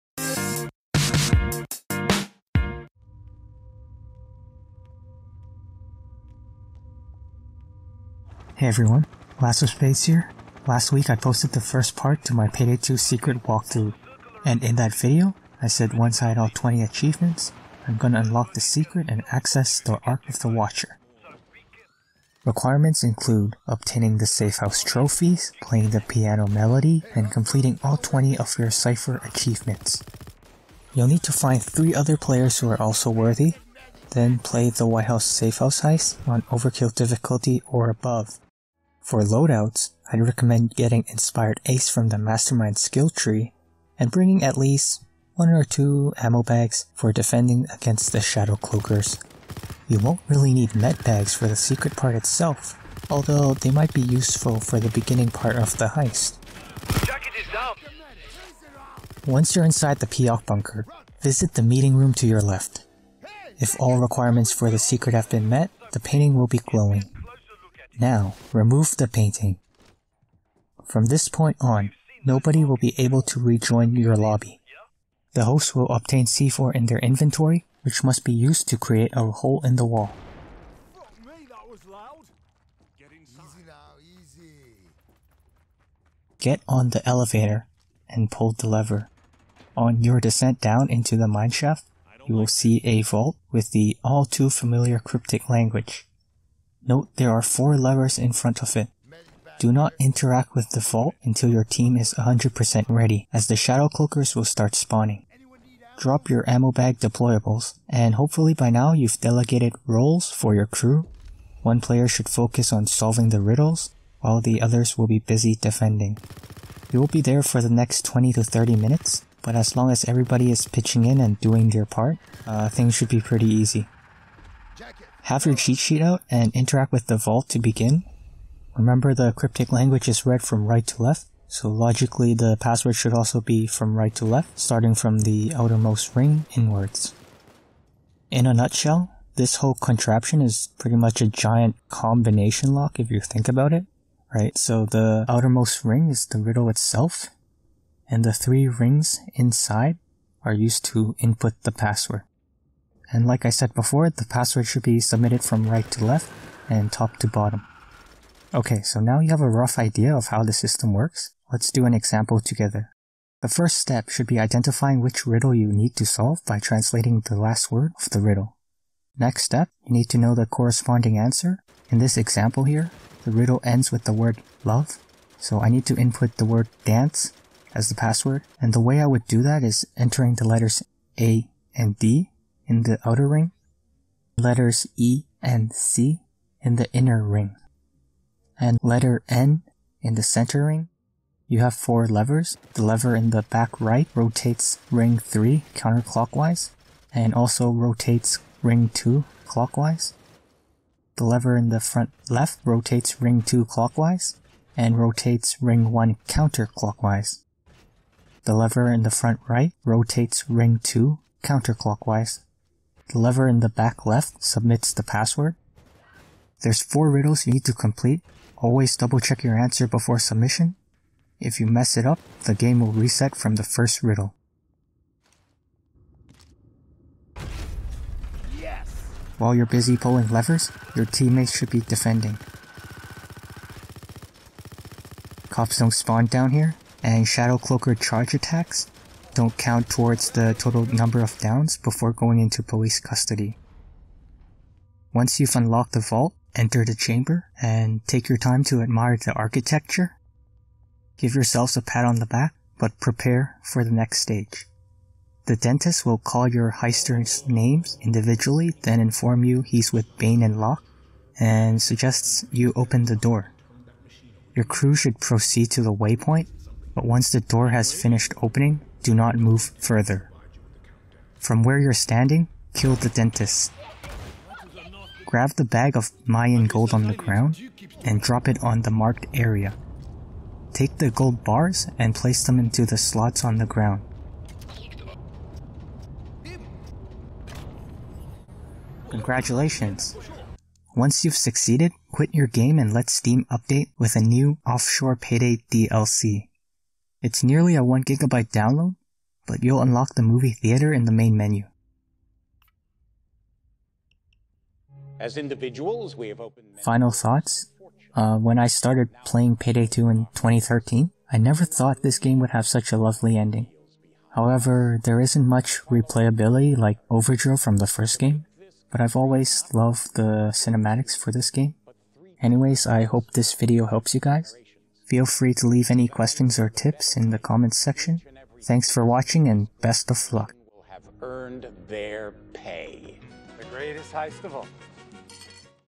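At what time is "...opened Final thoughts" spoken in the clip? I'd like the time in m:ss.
5:06.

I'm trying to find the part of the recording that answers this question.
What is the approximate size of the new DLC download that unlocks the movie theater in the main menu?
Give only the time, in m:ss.
4:57.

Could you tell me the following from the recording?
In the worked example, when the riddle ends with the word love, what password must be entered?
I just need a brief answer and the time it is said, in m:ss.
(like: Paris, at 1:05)
dance, at 2:56.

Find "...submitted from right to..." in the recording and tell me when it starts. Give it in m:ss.
2:35.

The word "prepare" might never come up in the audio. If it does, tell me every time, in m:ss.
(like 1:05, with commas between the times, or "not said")
4:12.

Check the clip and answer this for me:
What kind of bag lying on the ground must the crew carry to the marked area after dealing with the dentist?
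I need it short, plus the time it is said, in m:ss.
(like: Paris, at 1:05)
Mayan gold, at 4:36.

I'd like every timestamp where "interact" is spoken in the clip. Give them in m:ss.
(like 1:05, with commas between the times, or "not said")
1:39, 2:06.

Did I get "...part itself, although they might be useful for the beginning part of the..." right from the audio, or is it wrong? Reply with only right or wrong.
right.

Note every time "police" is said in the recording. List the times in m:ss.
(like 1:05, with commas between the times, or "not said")
4:02.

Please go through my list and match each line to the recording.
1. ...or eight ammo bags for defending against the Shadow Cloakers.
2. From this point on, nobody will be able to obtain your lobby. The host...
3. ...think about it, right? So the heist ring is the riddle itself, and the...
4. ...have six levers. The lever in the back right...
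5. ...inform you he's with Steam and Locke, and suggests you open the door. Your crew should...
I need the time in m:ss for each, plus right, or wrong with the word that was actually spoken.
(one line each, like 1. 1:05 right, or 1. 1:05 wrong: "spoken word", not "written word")
1. 0:45 wrong: "two", not "eight"
2. 1:10 wrong: "rejoin", not "obtain"
3. 2:23 wrong: "outermost", not "heist"
4. 3:11 wrong: "four", not "six"
5. 4:18 wrong: "Bain", not "Steam".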